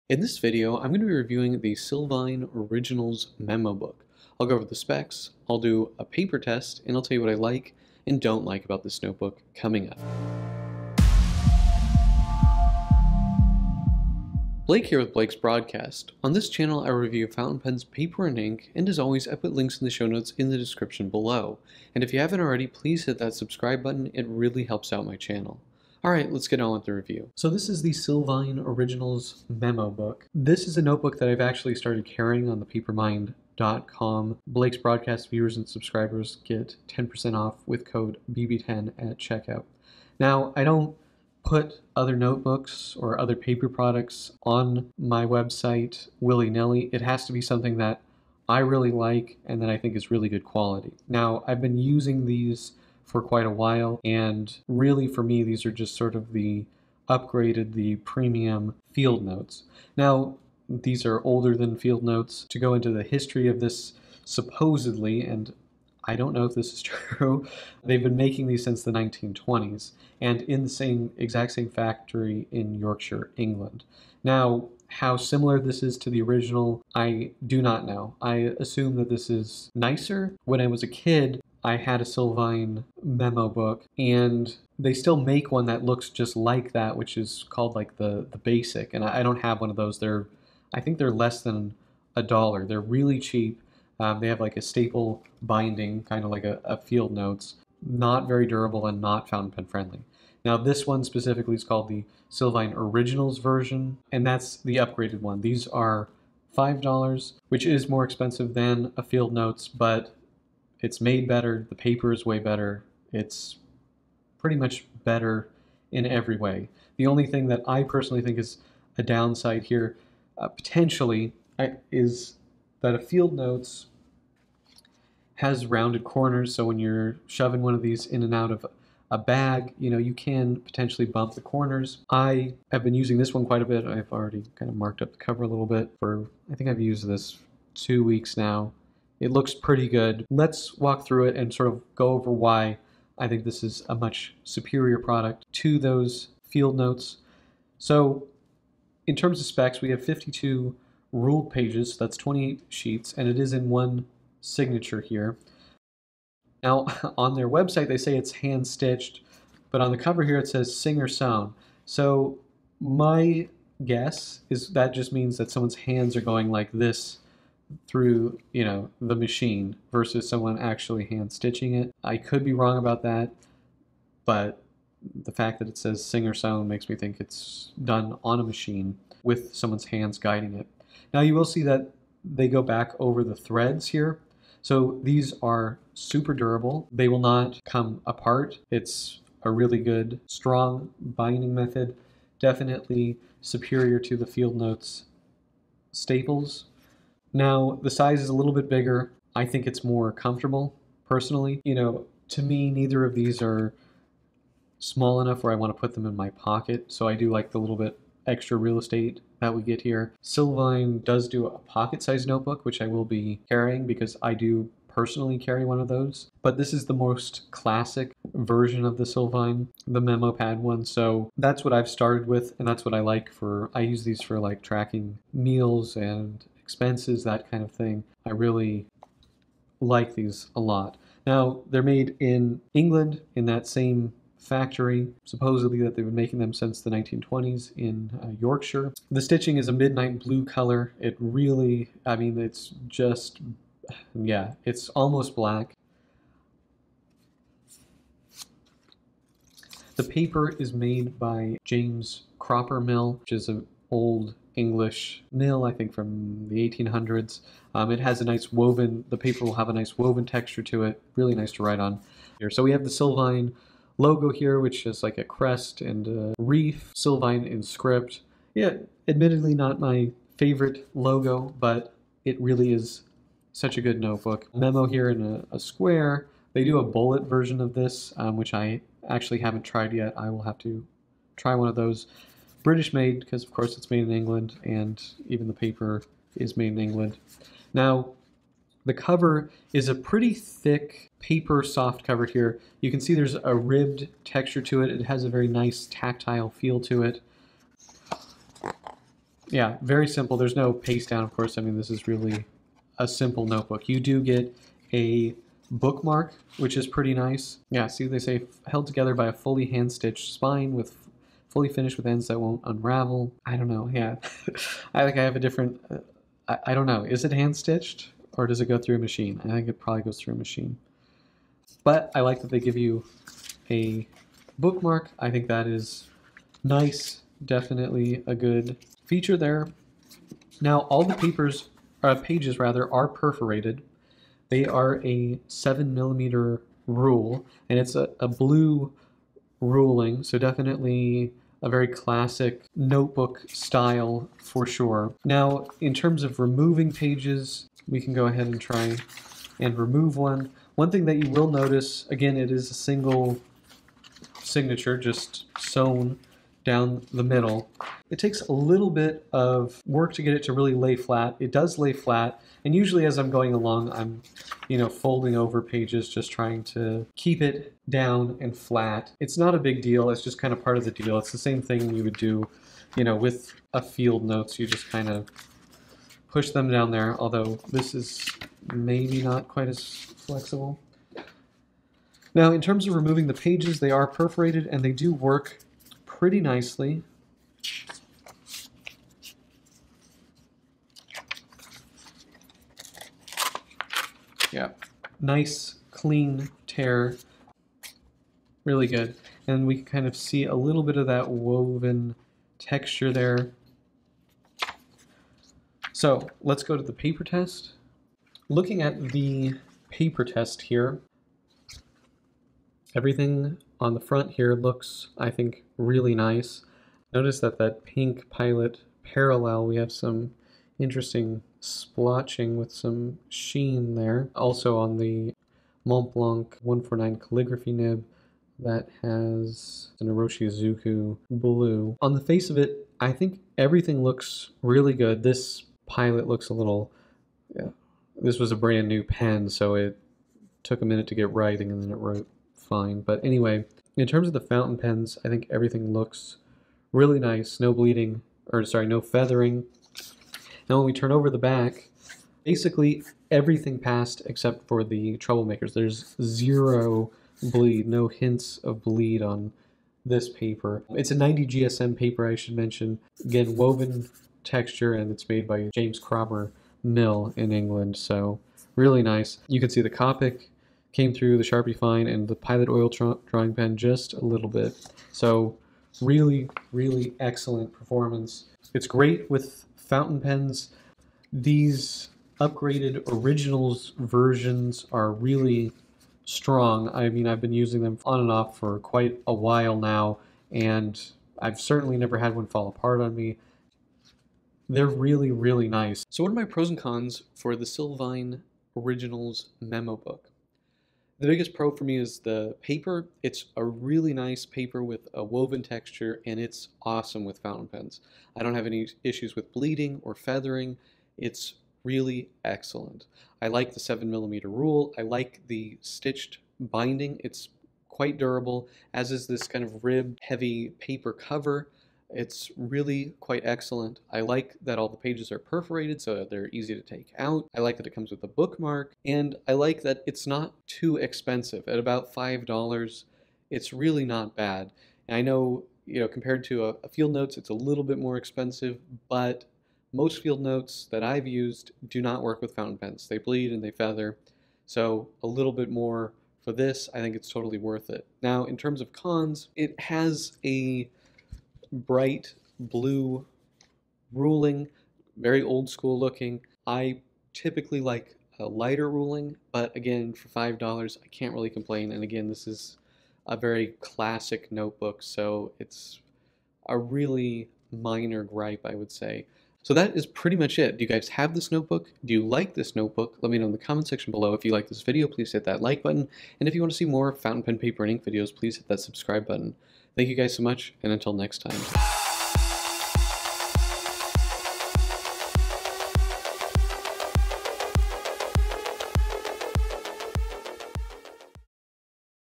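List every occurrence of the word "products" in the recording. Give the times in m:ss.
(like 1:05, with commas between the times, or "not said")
0:43, 2:24.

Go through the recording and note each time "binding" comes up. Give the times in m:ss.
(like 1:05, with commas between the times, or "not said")
1:35, 3:10, 8:36.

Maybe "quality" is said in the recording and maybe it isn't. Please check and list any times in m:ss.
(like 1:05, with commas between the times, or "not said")
0:50.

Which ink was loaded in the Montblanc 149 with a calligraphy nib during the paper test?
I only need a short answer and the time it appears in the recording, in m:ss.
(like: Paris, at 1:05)
Iroshizuku blue, at 7:10.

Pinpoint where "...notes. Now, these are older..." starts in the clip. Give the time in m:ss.
0:59.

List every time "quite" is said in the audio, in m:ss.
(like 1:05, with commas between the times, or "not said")
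0:53, 2:13, 6:19, 8:08, 8:37, 8:43.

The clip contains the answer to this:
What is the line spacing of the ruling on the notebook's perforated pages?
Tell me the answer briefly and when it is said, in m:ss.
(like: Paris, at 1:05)
7mm, at 5:35.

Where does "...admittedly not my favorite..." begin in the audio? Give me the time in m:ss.
4:29.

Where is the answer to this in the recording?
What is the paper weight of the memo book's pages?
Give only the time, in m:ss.
7:41.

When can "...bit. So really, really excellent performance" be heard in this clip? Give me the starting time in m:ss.
7:54.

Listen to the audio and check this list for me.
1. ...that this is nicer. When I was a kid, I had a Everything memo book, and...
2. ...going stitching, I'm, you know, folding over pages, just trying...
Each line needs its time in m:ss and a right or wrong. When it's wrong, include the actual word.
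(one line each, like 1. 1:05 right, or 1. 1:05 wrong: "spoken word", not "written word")
1. 1:18 wrong: "Silvine", not "Everything"
2. 6:03 wrong: "along", not "stitching".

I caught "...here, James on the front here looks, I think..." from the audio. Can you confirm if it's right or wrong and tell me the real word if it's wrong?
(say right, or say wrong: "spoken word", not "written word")
wrong: "Everything", not "James".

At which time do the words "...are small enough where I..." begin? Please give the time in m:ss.
3:23.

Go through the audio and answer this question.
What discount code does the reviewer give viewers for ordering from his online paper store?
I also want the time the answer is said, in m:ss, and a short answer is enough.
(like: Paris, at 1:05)
BB10, at 0:38.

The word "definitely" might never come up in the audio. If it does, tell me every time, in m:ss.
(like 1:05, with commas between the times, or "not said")
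3:12, 5:27, 5:40.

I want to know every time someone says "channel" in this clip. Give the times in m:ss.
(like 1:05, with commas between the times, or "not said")
0:16, 0:25.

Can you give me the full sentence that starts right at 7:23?
But anyway, in terms of the fountain pens, I think everything looks really nice.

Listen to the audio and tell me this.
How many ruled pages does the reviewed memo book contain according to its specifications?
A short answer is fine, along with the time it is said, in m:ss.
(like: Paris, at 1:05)
52, at 2:30.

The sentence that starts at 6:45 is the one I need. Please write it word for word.
So let's go to the paper test.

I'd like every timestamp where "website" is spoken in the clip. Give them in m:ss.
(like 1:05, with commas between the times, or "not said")
0:45, 2:37.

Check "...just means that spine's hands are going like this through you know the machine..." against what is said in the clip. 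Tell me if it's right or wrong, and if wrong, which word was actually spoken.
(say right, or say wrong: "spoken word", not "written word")
wrong: "someone", not "spine".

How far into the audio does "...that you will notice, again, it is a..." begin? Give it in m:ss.
5:51.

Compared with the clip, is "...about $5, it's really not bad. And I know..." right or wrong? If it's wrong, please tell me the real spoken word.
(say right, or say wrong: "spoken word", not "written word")
right.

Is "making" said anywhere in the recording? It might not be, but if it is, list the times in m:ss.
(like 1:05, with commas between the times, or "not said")
1:08, 3:56.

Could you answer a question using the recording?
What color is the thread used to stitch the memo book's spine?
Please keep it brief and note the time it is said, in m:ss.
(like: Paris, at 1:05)
Midnight blue, at 3:59.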